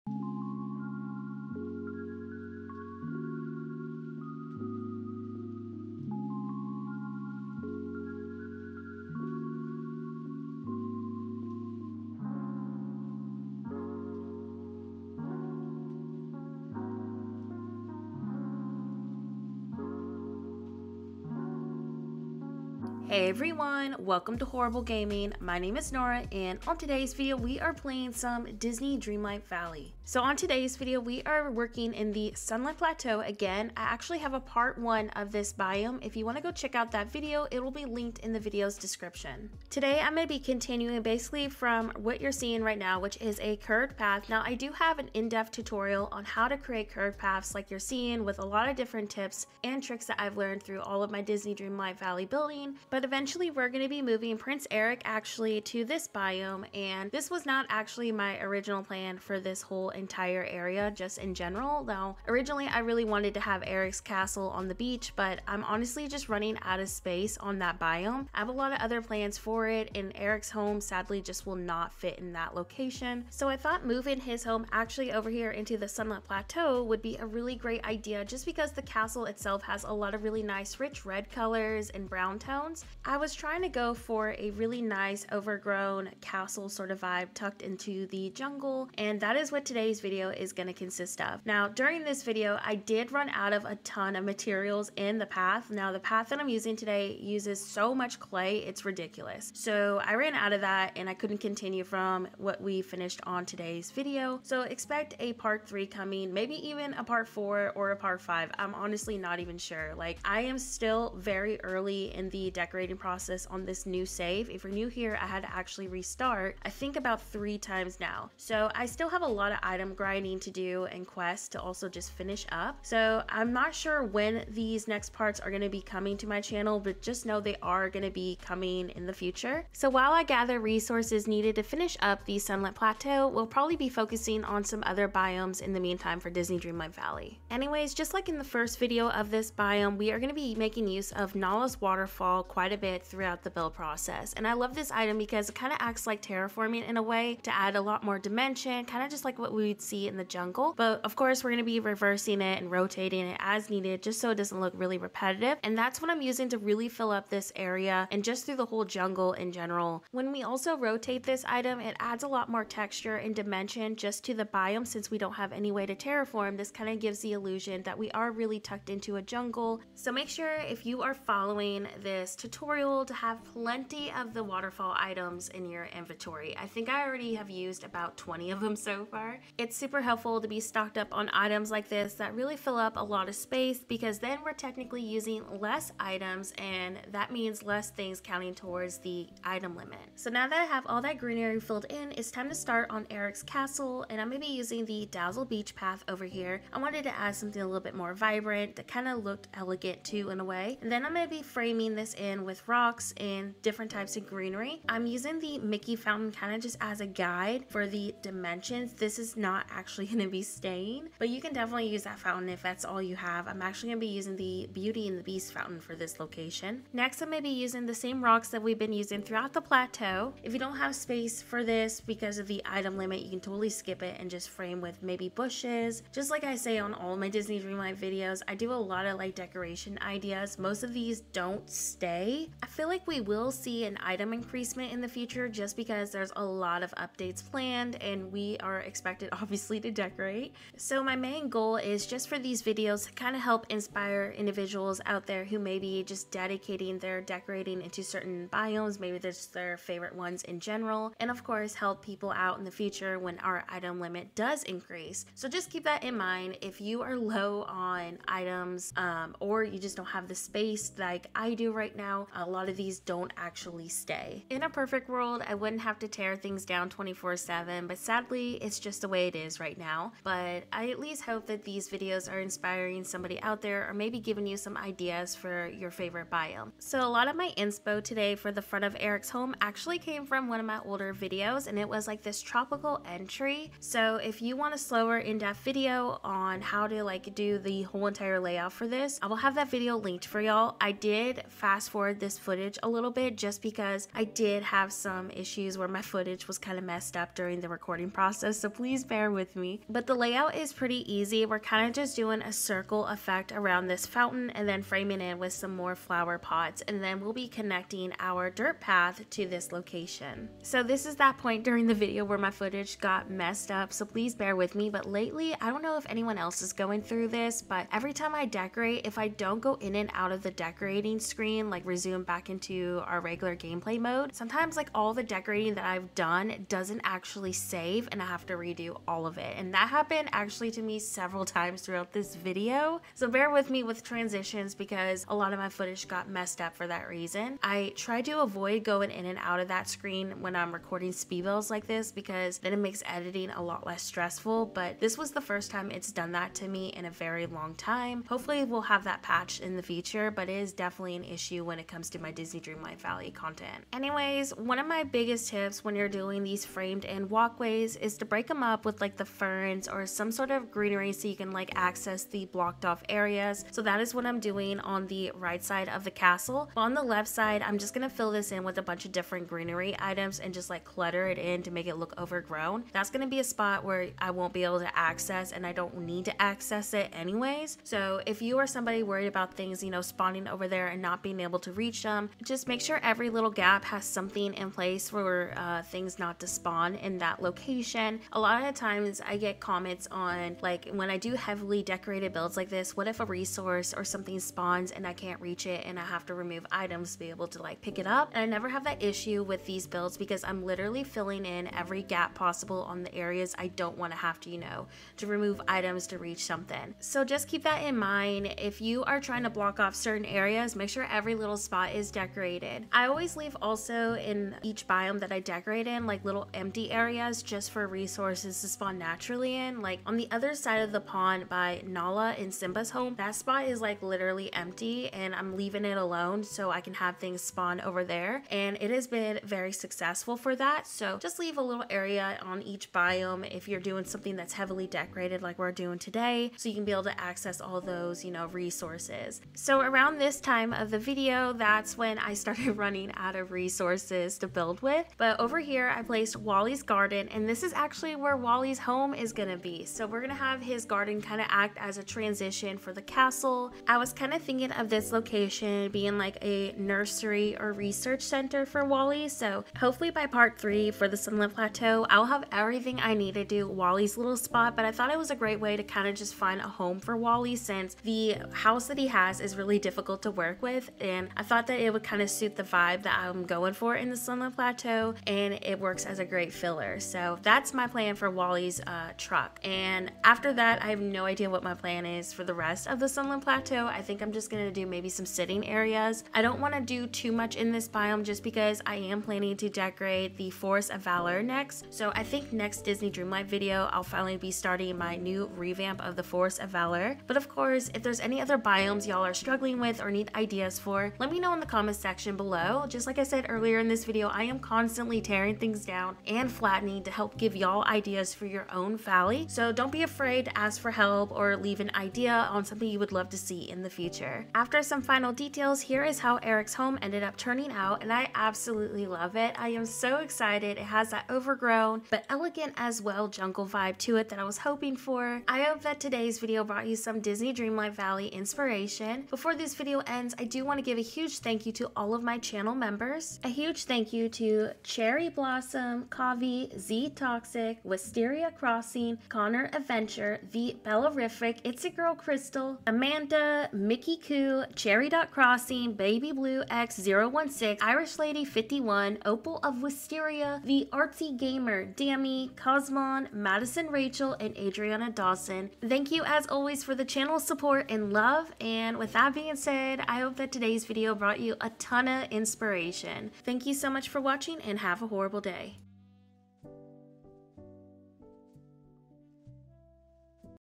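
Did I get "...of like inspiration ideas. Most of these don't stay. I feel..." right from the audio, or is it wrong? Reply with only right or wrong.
wrong.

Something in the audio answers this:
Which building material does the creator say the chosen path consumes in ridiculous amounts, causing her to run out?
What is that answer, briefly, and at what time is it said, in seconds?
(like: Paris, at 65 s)
Clay, at 98 s.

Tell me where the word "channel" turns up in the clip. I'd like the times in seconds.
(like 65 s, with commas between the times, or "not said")
126 s, 532 s, 557 s.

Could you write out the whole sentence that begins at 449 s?
So we're gonna have his garden kind of act as a transition for the castle.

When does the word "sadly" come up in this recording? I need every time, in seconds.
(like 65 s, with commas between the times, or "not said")
70 s, 267 s.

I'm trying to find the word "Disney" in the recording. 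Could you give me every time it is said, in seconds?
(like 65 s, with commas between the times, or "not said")
28 s, 51 s, 136 s, 227 s, 352 s, 492 s, 527 s.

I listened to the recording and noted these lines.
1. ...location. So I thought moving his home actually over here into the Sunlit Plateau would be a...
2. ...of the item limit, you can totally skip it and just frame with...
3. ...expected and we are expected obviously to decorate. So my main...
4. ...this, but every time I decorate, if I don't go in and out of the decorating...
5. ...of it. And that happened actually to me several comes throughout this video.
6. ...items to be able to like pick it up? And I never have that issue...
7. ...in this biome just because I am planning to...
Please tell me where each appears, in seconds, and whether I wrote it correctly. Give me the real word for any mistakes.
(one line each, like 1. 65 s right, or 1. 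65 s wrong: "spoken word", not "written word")
1. 72 s right
2. 222 s right
3. 237 s wrong: "planned", not "expected"
4. 317 s right
5. 329 s wrong: "times", not "comes"
6. 396 s right
7. 487 s right.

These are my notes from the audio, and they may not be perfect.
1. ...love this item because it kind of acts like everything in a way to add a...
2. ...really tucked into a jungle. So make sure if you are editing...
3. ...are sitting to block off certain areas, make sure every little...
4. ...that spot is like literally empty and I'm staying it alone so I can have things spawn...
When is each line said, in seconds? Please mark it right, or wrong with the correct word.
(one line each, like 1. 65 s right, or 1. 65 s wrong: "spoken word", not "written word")
1. 144 s wrong: "terraforming", not "everything"
2. 168 s wrong: "following", not "editing"
3. 409 s wrong: "trying", not "sitting"
4. 423 s wrong: "leaving", not "staying".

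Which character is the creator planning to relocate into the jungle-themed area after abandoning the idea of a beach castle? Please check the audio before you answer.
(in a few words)
Prince Eric.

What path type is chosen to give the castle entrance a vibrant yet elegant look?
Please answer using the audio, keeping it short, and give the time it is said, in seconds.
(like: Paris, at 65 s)
Dazzle Beach Path, at 195 s.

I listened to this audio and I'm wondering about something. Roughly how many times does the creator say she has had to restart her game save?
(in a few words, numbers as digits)
3.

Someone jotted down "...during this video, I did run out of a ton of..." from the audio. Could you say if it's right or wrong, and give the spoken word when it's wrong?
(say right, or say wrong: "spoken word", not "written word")
right.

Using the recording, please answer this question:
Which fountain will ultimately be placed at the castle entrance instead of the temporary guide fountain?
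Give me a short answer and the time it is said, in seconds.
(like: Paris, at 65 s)
Beauty and the Beast fountain, at 214 s.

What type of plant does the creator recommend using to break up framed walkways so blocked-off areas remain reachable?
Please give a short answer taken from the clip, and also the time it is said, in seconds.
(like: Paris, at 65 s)
Ferns, at 359 s.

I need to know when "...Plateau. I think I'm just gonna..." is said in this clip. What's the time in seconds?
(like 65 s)
483 s.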